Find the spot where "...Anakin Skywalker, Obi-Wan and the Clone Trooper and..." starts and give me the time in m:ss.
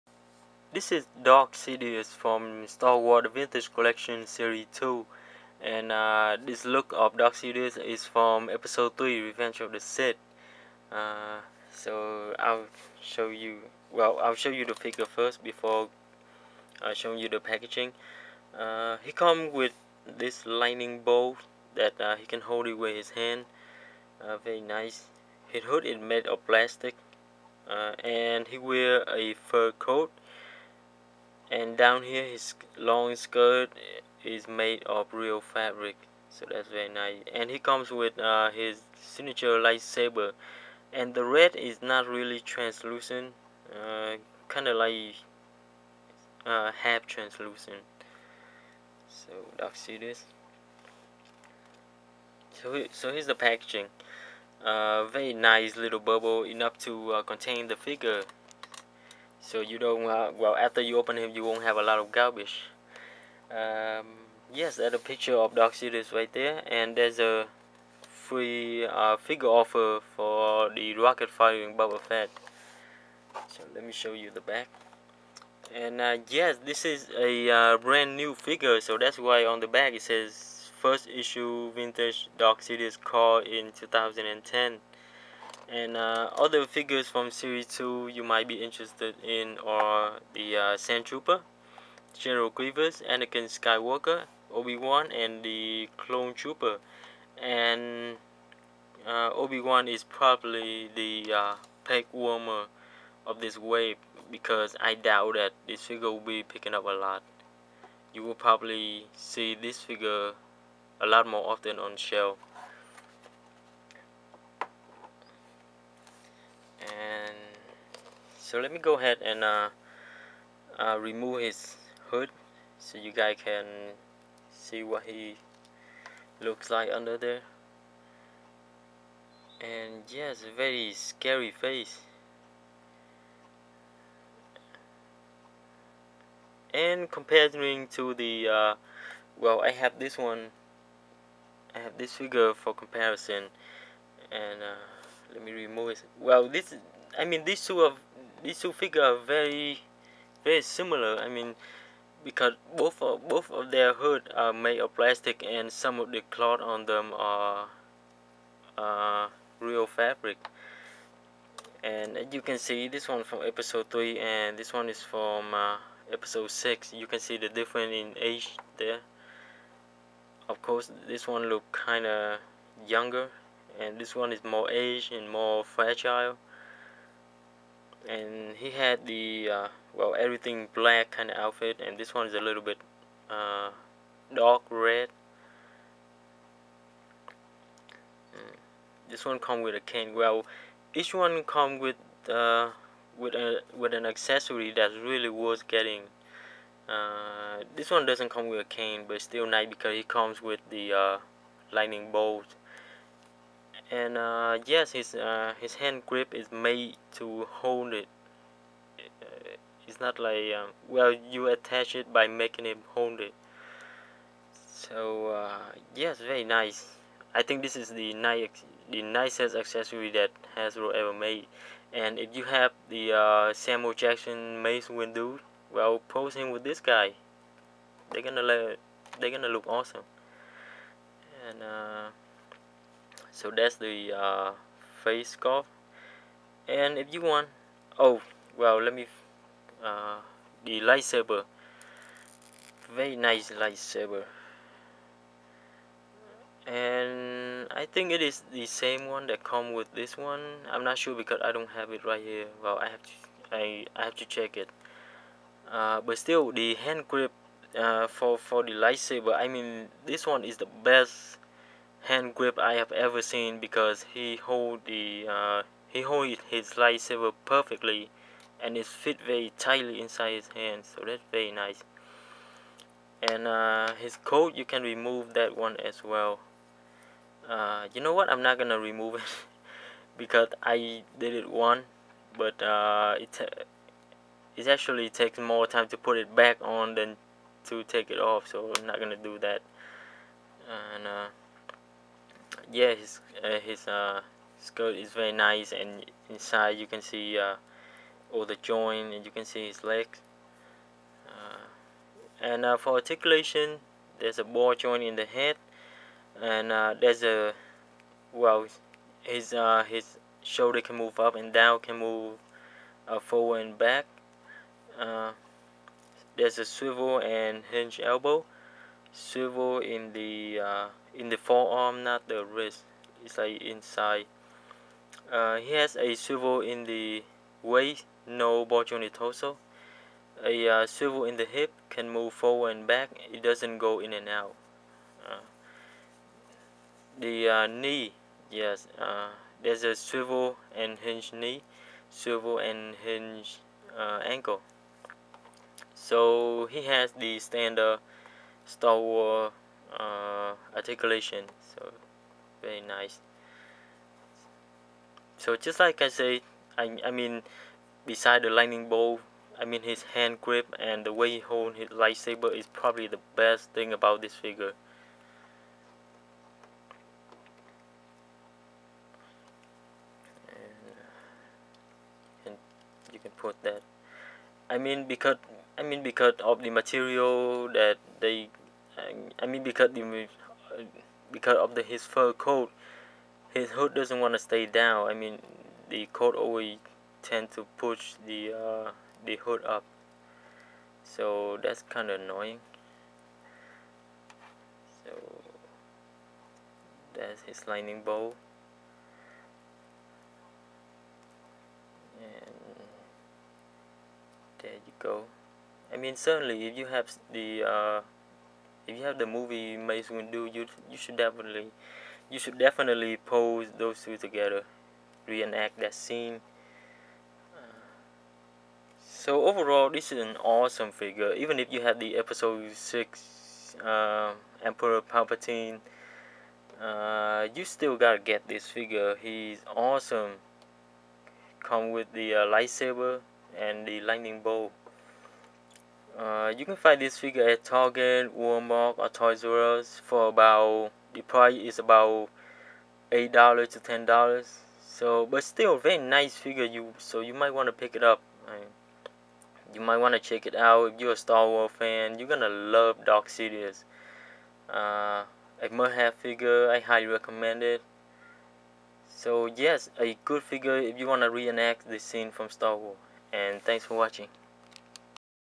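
1:33.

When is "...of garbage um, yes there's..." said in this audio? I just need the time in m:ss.
1:01.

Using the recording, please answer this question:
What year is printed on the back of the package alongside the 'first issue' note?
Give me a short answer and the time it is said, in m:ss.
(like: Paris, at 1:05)
2010, at 1:23.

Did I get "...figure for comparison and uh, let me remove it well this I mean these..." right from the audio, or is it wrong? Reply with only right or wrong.
right.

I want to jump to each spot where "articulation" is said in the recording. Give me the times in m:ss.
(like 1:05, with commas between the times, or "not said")
5:02, 5:50.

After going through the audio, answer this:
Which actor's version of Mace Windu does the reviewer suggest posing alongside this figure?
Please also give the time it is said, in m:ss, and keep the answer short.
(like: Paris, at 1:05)
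Samuel Jackson, at 3:43.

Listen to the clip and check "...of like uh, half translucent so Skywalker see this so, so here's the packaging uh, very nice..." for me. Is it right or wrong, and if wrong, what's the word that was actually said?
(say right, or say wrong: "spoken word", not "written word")
wrong: "Dark", not "Skywalker".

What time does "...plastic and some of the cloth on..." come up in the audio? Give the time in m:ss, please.
2:34.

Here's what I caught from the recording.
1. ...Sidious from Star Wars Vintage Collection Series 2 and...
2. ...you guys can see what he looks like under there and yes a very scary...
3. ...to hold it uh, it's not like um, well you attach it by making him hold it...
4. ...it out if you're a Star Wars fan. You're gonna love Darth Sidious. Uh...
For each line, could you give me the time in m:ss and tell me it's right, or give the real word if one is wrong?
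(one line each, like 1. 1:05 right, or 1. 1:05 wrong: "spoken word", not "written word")
1. 0:01 right
2. 2:02 right
3. 3:27 right
4. 7:30 right.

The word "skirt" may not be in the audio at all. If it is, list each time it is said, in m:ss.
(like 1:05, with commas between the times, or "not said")
0:33, 4:54.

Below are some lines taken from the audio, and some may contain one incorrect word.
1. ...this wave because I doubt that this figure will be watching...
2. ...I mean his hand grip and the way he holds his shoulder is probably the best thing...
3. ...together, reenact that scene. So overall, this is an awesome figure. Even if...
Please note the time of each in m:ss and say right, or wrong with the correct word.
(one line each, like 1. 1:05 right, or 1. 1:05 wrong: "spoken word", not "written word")
1. 1:43 wrong: "picking", not "watching"
2. 5:59 wrong: "lightsaber", not "shoulder"
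3. 6:54 right.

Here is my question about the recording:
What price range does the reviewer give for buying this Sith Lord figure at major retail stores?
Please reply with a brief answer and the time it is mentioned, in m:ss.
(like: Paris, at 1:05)
$8 to $10, at 7:23.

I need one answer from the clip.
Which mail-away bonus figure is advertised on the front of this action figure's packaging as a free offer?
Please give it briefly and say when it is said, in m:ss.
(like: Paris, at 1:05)
Rocket firing Boba Fett, at 1:10.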